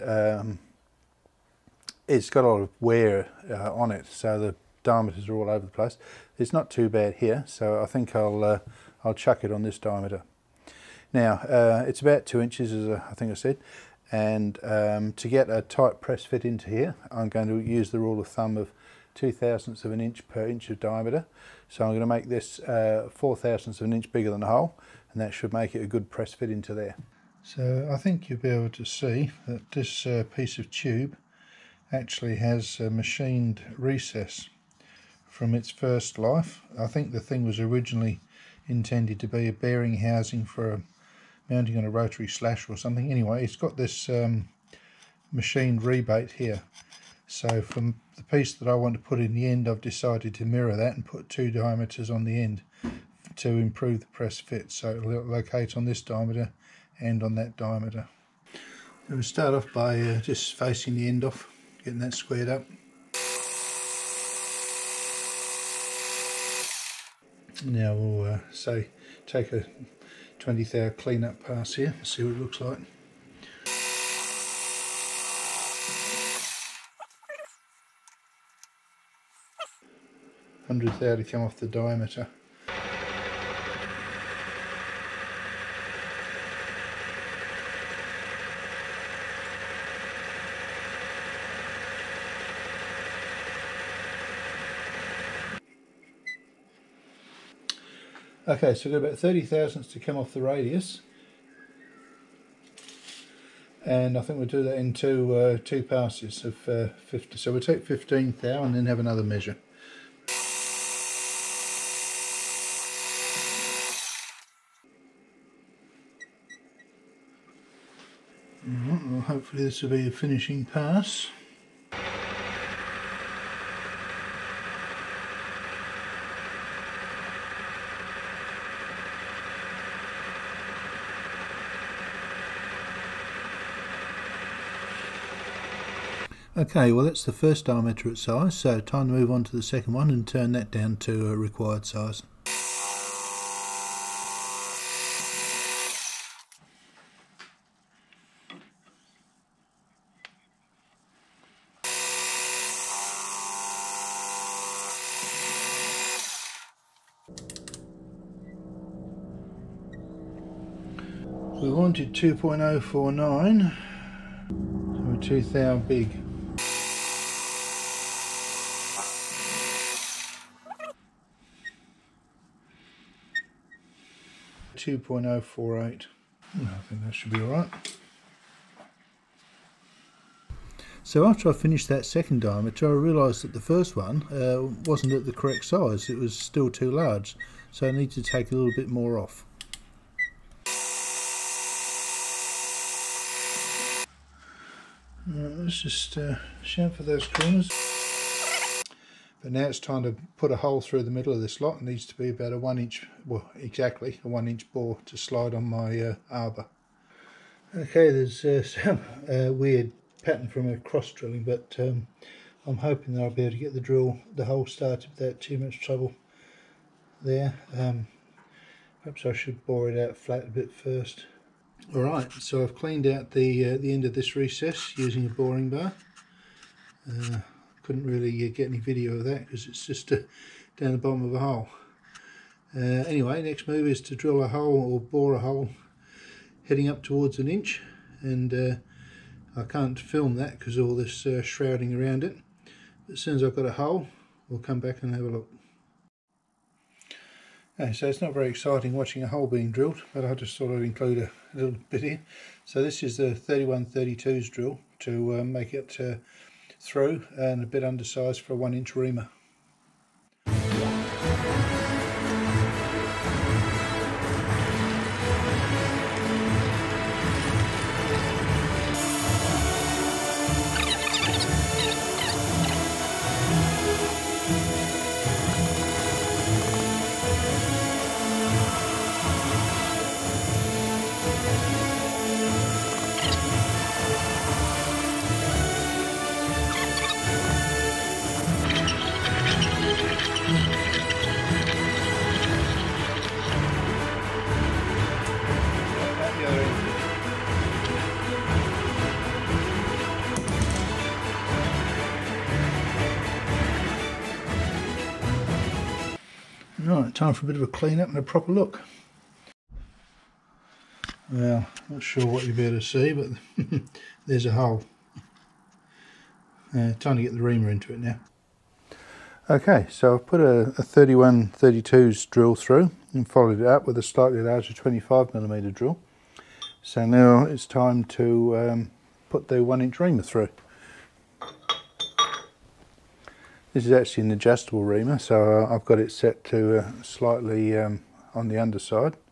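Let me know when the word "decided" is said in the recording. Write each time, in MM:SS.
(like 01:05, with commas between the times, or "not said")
00:49.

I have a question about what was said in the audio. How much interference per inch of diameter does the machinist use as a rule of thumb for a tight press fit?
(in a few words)
2 thousandths of an inch.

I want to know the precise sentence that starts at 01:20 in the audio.
Hundredth to come off the diameter.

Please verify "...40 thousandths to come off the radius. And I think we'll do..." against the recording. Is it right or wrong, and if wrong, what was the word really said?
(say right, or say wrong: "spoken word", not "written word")
wrong: "30", not "40".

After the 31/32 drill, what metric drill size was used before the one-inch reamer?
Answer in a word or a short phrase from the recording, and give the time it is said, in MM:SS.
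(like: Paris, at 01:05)
25 millimeters, at 05:24.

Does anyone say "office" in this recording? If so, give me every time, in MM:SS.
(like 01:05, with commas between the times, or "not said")
not said.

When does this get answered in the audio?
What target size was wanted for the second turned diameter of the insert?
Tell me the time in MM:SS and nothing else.
02:42.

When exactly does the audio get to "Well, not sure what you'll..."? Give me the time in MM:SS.
05:11.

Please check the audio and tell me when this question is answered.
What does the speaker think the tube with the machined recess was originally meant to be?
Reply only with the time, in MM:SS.
00:39.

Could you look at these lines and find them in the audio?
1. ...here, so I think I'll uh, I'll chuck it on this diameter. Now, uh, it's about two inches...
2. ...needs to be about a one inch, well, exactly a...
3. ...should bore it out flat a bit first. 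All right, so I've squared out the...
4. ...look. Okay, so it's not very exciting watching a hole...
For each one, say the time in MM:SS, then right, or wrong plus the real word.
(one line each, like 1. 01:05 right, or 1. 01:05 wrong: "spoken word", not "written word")
1. 00:07 right
2. 03:21 right
3. 03:39 wrong: "cleaned", not "squared"
4. 04:05 right.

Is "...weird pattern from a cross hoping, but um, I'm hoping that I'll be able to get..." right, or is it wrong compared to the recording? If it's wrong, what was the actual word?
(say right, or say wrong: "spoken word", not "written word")
wrong: "drilling", not "hoping".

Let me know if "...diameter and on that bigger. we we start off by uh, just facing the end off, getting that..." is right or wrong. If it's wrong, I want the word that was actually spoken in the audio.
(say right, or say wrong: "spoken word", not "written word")
wrong: "diameter", not "bigger".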